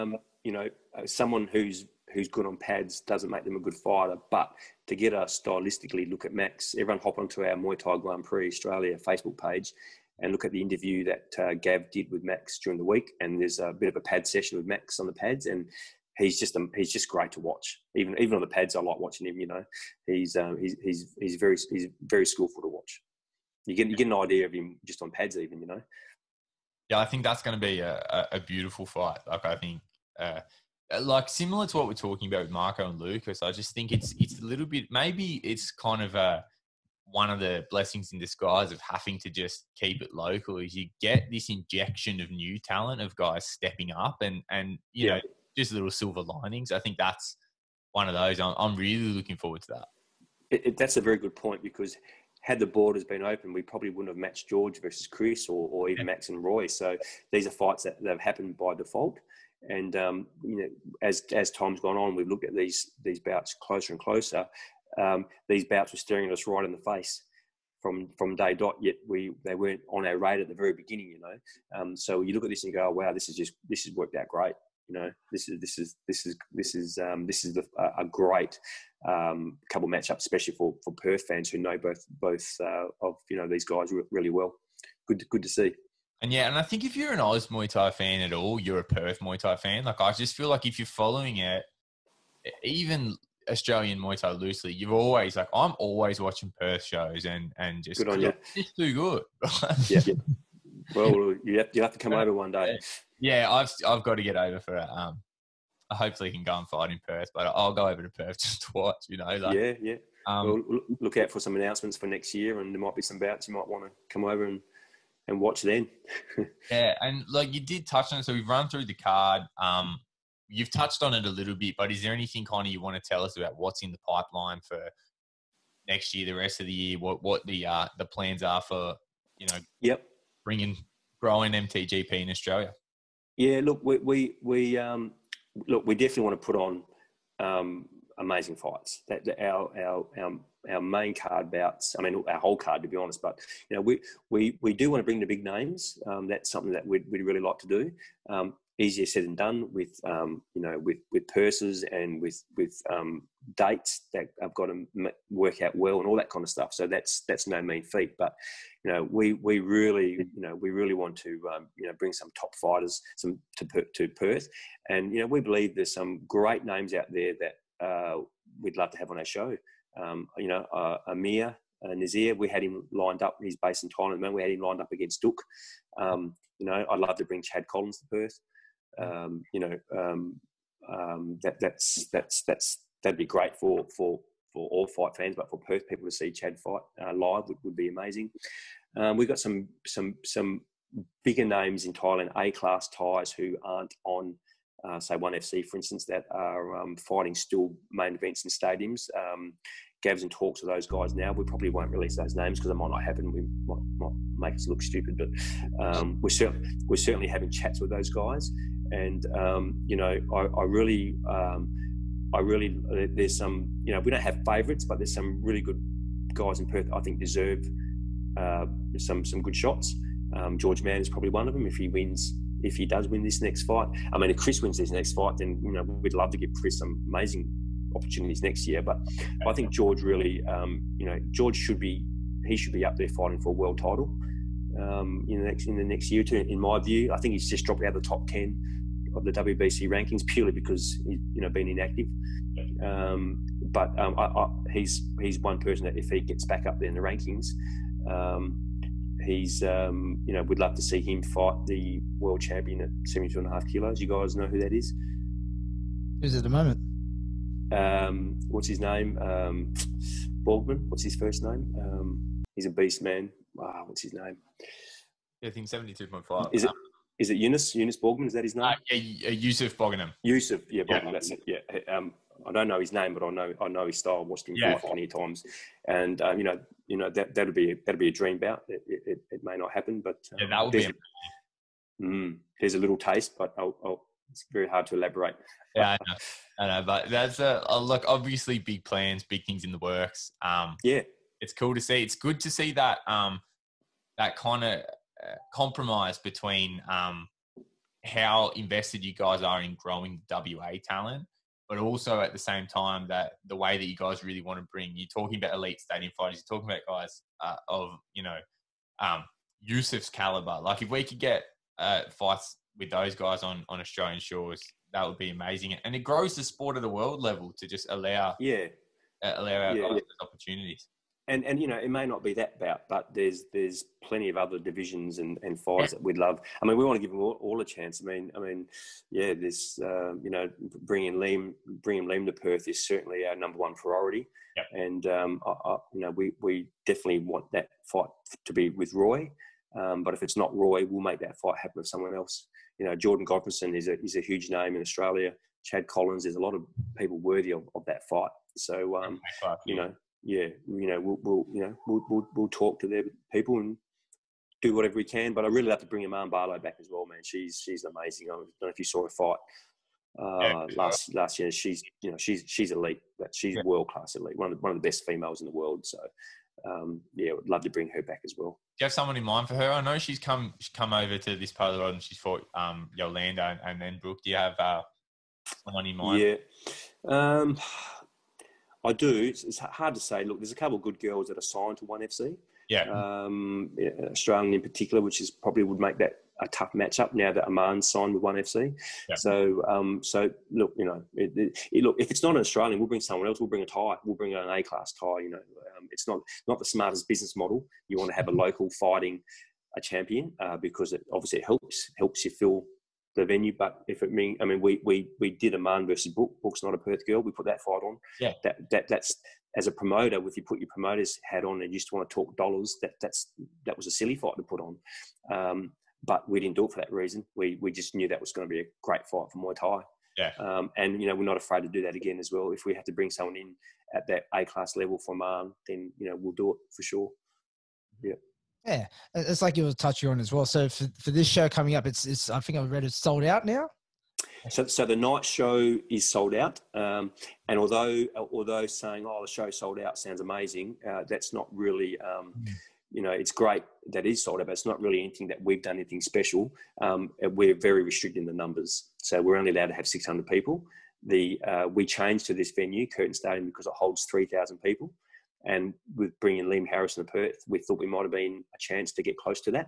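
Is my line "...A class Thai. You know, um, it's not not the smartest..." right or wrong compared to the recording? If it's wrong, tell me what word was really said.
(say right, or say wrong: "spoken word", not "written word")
right.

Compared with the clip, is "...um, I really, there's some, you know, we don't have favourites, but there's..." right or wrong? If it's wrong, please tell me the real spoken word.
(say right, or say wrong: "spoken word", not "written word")
right.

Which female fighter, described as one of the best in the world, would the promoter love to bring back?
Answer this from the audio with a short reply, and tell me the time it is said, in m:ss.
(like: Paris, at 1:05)
Iman Barlow, at 5:56.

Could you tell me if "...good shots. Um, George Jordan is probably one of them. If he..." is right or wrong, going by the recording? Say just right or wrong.
wrong.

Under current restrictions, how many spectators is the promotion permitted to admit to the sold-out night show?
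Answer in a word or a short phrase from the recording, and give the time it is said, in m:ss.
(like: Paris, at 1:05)
600, at 7:29.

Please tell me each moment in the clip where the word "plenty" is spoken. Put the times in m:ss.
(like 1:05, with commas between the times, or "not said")
4:34, 5:24.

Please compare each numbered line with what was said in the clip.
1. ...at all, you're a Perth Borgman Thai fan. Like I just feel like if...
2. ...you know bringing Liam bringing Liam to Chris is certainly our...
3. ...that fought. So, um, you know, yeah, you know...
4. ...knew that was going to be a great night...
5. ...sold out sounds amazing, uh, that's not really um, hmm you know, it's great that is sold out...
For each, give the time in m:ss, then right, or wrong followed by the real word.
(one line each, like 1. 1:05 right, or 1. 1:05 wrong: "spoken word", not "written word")
1. 1:28 wrong: "Muay", not "Borgman"
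2. 5:30 wrong: "Perth", not "Chris"
3. 5:47 wrong: "fight", not "fought"
4. 6:57 wrong: "fight", not "night"
5. 7:19 right.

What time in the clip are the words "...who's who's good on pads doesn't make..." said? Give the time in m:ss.
0:01.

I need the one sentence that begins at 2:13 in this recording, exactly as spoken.
Yeah, look, we we, we um, look, we definitely want to put on um, amazing fights.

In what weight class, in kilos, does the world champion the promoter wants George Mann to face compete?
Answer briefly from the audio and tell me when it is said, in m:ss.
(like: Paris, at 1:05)
72.5 kilos, at 4:13.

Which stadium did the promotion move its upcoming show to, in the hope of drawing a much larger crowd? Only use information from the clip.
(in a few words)
Curtin Stadium.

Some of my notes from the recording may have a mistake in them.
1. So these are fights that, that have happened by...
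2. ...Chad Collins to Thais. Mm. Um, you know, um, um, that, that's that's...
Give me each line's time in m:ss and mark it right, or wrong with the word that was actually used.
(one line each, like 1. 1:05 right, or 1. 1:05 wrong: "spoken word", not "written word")
1. 0:56 right
2. 2:57 wrong: "Perth", not "Thais".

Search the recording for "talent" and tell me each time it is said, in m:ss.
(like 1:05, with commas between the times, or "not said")
0:42, 5:00.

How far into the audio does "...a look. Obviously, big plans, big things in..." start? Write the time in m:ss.
4:47.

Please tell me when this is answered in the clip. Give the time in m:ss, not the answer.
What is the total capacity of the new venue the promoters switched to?
7:34.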